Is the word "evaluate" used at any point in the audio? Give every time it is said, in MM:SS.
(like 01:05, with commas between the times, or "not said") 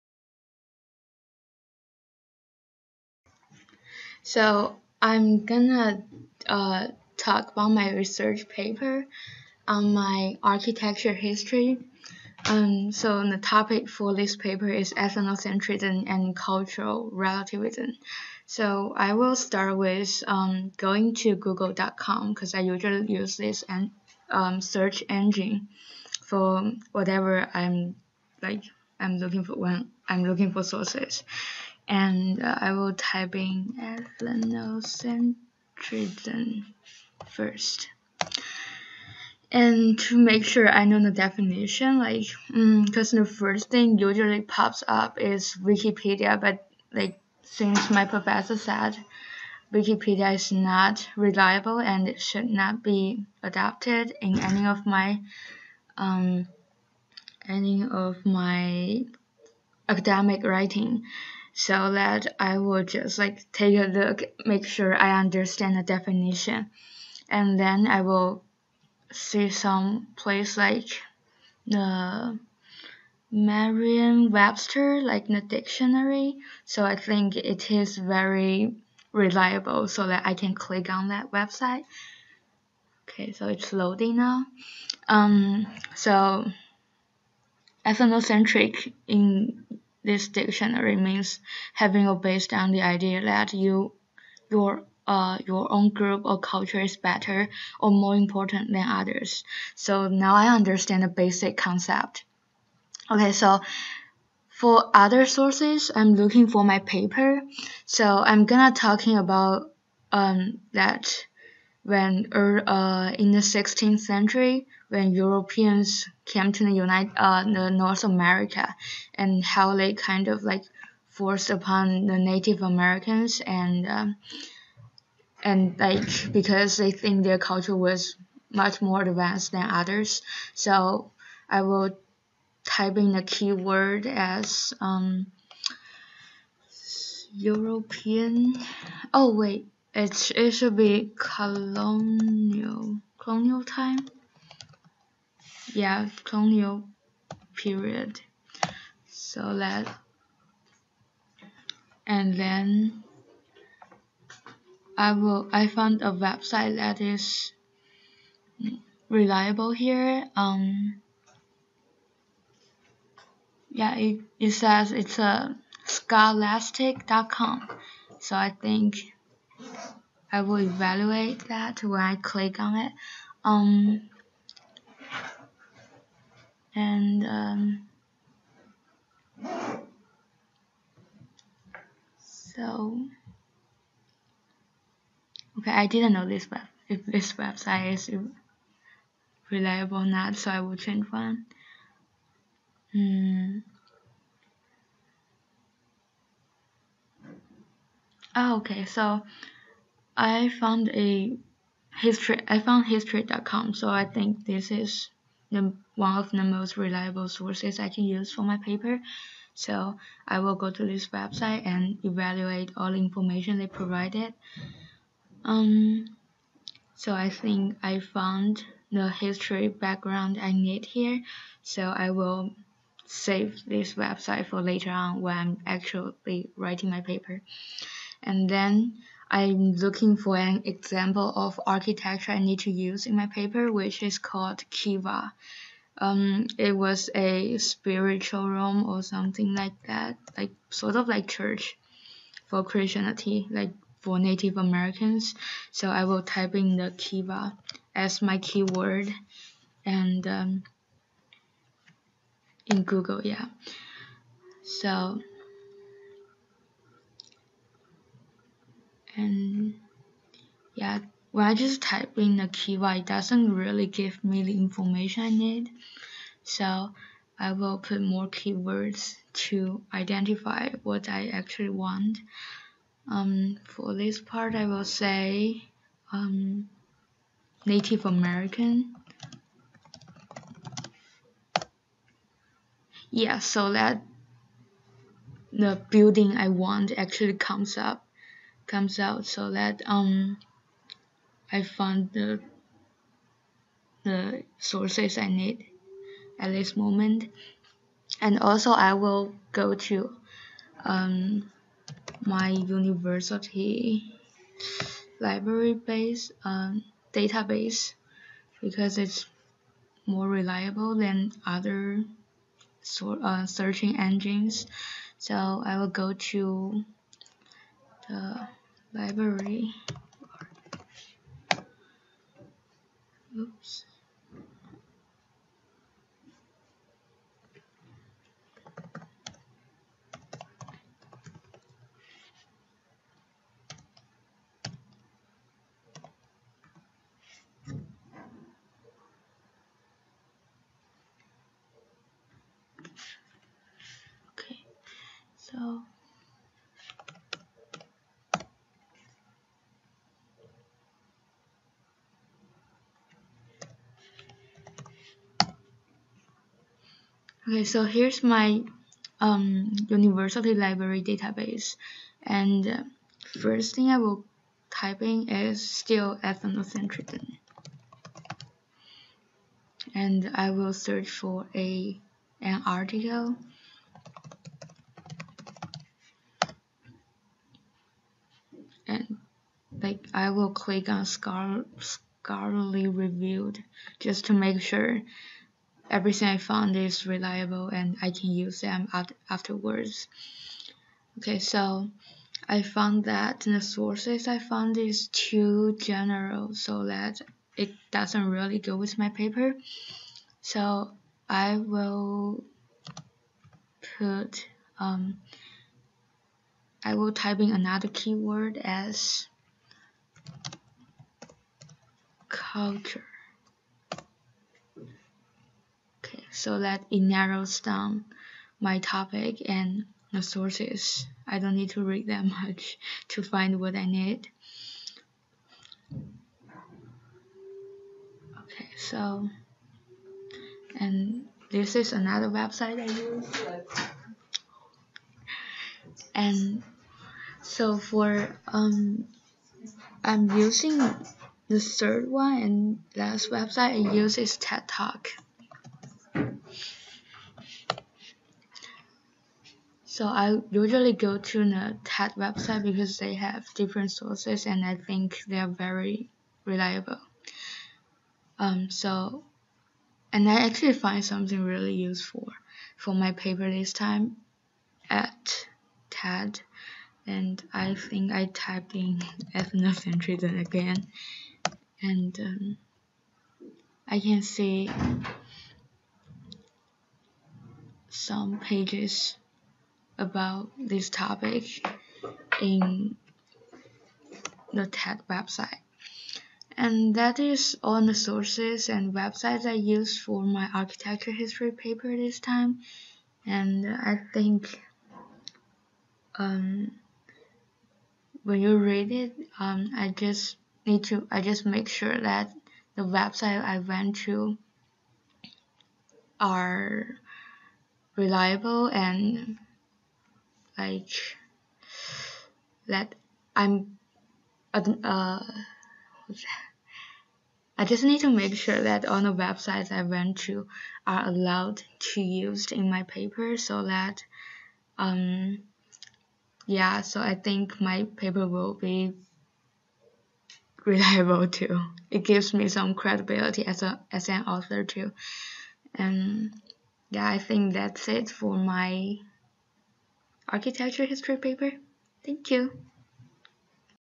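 02:50, 03:32.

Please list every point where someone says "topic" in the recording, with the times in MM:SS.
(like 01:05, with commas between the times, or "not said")
00:13, 06:58, 08:00.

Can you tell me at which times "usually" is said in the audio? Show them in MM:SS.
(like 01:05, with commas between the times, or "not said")
00:22, 00:43, 07:30.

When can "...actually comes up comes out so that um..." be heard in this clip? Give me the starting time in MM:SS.
04:46.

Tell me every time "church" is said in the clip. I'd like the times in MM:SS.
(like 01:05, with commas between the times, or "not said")
04:01.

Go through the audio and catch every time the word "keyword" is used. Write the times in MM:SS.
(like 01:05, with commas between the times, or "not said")
02:13, 04:08, 04:22, 04:28, 06:47.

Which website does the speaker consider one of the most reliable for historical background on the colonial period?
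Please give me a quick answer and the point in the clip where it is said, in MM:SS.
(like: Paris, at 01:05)
history.com, at 03:22.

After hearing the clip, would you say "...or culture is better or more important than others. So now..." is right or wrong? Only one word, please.
right.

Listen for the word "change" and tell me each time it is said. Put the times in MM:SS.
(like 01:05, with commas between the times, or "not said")
03:10.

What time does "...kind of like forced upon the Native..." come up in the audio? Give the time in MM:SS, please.
01:59.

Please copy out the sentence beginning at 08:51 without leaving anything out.
It gives me some credibility as a as an author too.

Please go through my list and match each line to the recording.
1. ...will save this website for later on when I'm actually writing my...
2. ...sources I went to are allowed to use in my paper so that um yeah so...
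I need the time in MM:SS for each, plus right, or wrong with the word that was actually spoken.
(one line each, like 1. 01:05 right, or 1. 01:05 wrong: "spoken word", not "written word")
1. 03:42 right
2. 08:39 wrong: "websites", not "sources".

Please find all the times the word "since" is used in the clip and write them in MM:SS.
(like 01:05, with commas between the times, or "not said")
00:47.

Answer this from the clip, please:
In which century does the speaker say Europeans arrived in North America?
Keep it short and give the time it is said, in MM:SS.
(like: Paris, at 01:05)
16th century, at 01:53.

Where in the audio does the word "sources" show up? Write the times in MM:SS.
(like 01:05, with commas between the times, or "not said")
00:30, 01:45, 03:27, 04:54, 06:33, 07:00, 07:33, 08:07.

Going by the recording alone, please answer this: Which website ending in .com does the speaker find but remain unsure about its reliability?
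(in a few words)
scholastic.com.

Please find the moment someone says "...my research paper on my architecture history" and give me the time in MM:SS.
00:07.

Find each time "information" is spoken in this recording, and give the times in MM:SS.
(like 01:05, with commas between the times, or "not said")
03:32, 04:24.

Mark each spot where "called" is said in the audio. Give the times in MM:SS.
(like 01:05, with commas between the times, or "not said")
03:54.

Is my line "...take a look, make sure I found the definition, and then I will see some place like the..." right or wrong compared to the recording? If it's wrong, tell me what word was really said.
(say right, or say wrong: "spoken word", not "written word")
wrong: "understand", not "found".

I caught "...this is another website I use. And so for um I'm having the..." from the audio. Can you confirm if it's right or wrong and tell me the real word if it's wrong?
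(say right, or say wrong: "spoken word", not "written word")
wrong: "using", not "having".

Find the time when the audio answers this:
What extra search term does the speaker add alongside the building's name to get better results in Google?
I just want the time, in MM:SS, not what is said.
04:37.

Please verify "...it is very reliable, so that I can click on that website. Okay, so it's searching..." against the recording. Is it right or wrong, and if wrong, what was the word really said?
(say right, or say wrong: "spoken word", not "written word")
wrong: "loading", not "searching".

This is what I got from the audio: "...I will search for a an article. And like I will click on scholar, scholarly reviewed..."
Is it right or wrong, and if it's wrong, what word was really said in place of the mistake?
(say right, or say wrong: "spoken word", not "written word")
right.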